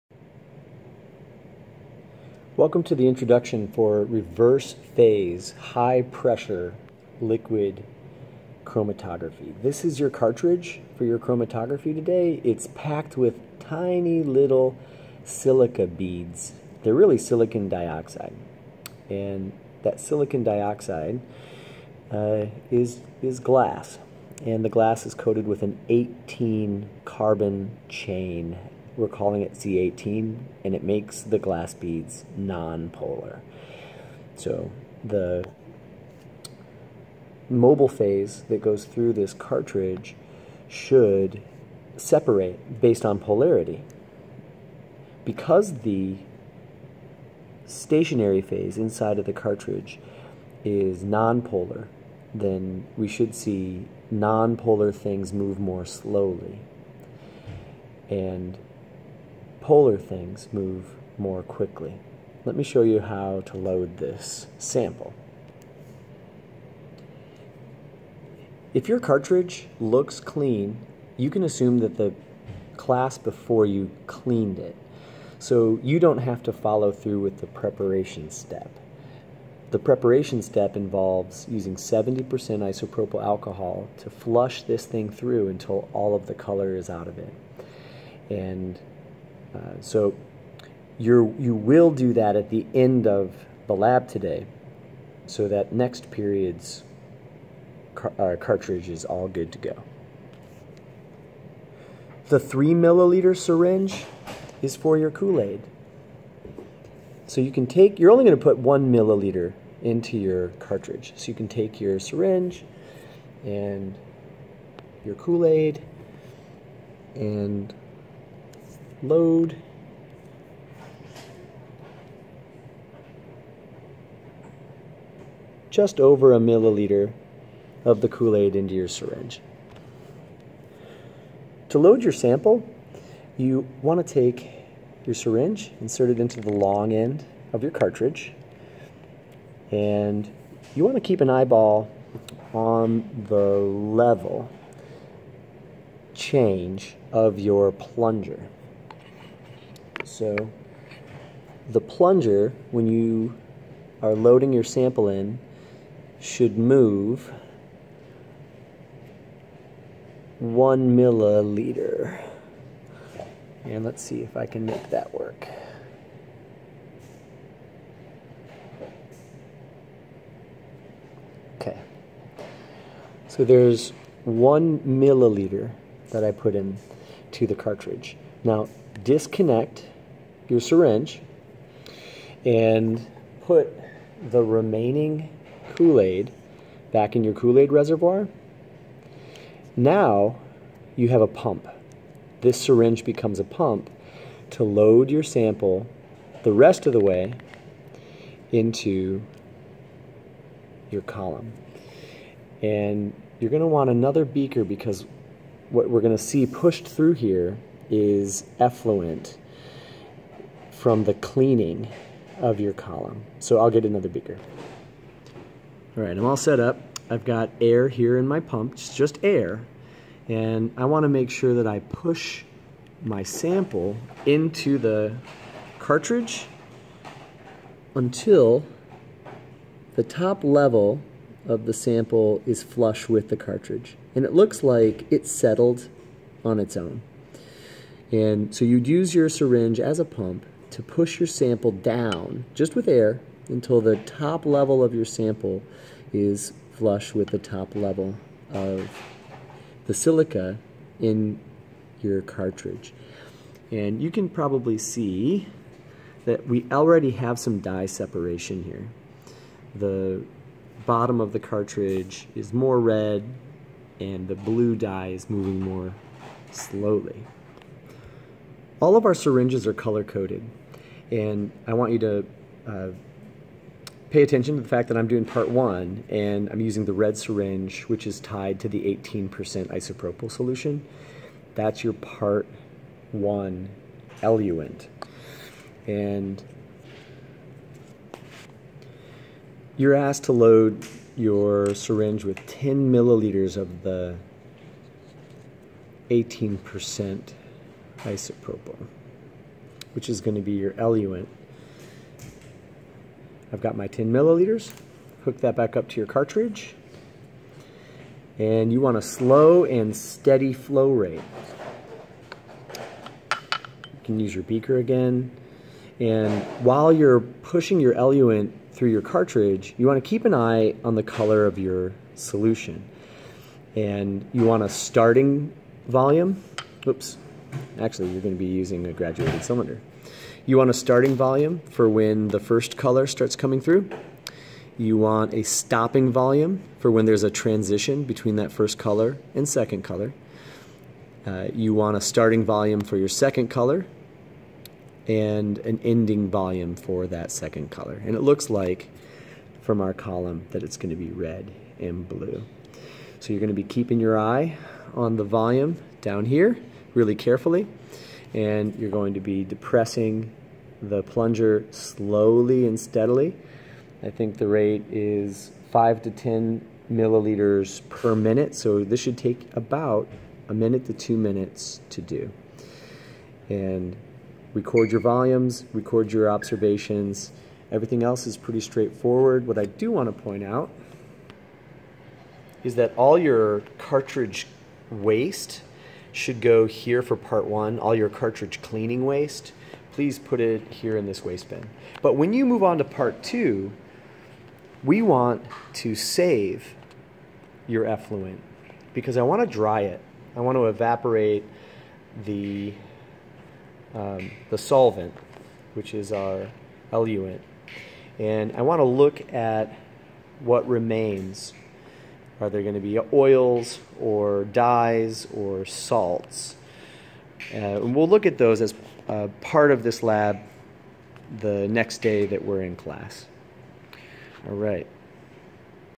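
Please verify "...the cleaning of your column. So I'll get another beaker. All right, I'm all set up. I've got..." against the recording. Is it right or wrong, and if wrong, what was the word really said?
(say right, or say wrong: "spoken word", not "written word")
right.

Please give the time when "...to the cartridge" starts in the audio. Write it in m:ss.
2:57.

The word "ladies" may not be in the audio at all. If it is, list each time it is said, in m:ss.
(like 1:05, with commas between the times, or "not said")
not said.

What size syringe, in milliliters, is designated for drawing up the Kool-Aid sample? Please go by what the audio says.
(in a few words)
3 milliliters.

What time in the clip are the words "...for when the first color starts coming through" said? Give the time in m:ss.
5:31.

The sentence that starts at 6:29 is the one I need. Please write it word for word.
Please put it here in this waste bin.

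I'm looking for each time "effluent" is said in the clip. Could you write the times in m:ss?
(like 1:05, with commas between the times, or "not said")
3:28, 6:37.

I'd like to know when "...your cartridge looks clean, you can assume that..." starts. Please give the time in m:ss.
1:08.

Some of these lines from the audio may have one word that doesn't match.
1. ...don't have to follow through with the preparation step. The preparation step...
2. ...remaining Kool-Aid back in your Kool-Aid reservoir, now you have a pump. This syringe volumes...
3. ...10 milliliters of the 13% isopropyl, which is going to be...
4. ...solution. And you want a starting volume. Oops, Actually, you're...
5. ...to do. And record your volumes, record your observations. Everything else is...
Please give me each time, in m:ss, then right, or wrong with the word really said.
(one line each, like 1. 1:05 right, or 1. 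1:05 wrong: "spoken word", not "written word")
1. 1:15 right
2. 3:04 wrong: "becomes", not "volumes"
3. 4:52 wrong: "18", not "13"
4. 5:22 right
5. 6:11 right.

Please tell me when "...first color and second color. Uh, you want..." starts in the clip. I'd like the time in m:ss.
5:38.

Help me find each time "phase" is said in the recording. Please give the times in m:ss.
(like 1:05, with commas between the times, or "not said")
0:04, 0:37, 0:48.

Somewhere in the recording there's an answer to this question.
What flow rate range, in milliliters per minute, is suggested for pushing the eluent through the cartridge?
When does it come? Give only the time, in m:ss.
6:05.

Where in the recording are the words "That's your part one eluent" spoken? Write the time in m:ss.
4:41.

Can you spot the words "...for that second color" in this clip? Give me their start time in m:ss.
5:46.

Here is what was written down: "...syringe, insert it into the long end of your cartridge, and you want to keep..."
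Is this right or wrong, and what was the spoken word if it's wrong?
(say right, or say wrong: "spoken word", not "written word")
right.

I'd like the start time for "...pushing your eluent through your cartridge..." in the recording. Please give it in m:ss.
5:17.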